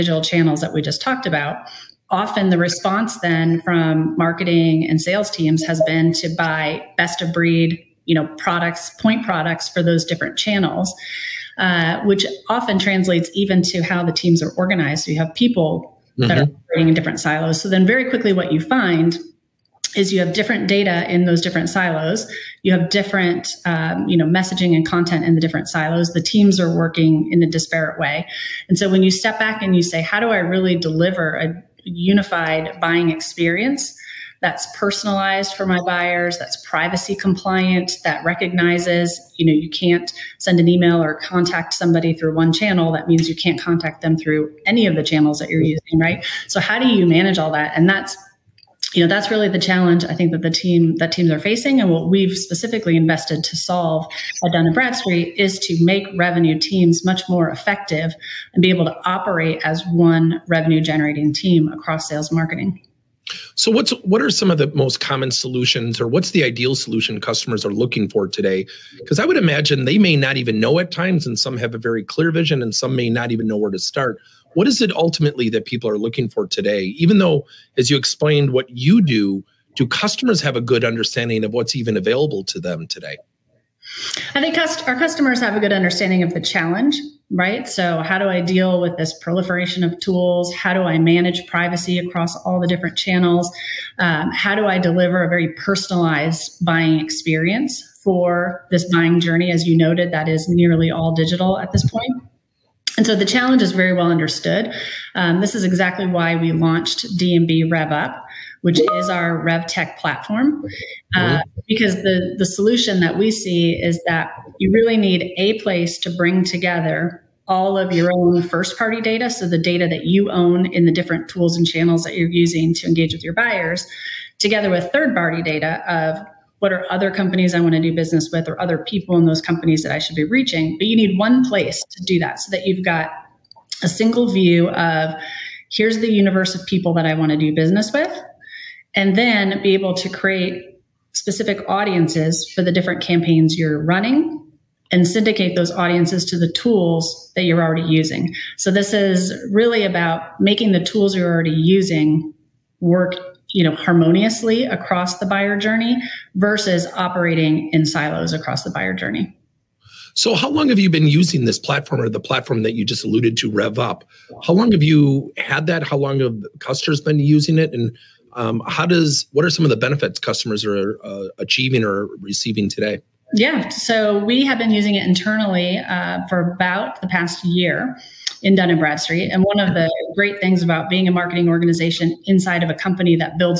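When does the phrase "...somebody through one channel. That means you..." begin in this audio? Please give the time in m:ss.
0:41.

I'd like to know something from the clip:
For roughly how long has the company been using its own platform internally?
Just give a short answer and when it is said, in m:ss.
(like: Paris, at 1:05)
About the past year, at 2:56.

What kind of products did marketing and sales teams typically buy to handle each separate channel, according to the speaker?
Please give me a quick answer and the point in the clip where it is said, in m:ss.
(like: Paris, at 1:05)
Best of breed, at 0:06.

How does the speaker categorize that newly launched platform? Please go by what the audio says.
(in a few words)
RevTech platform.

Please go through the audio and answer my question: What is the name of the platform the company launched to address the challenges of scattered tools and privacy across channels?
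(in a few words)
D&B RevUp.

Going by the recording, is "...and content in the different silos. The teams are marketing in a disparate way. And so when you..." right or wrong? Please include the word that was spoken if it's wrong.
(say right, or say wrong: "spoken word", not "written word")
wrong: "working", not "marketing".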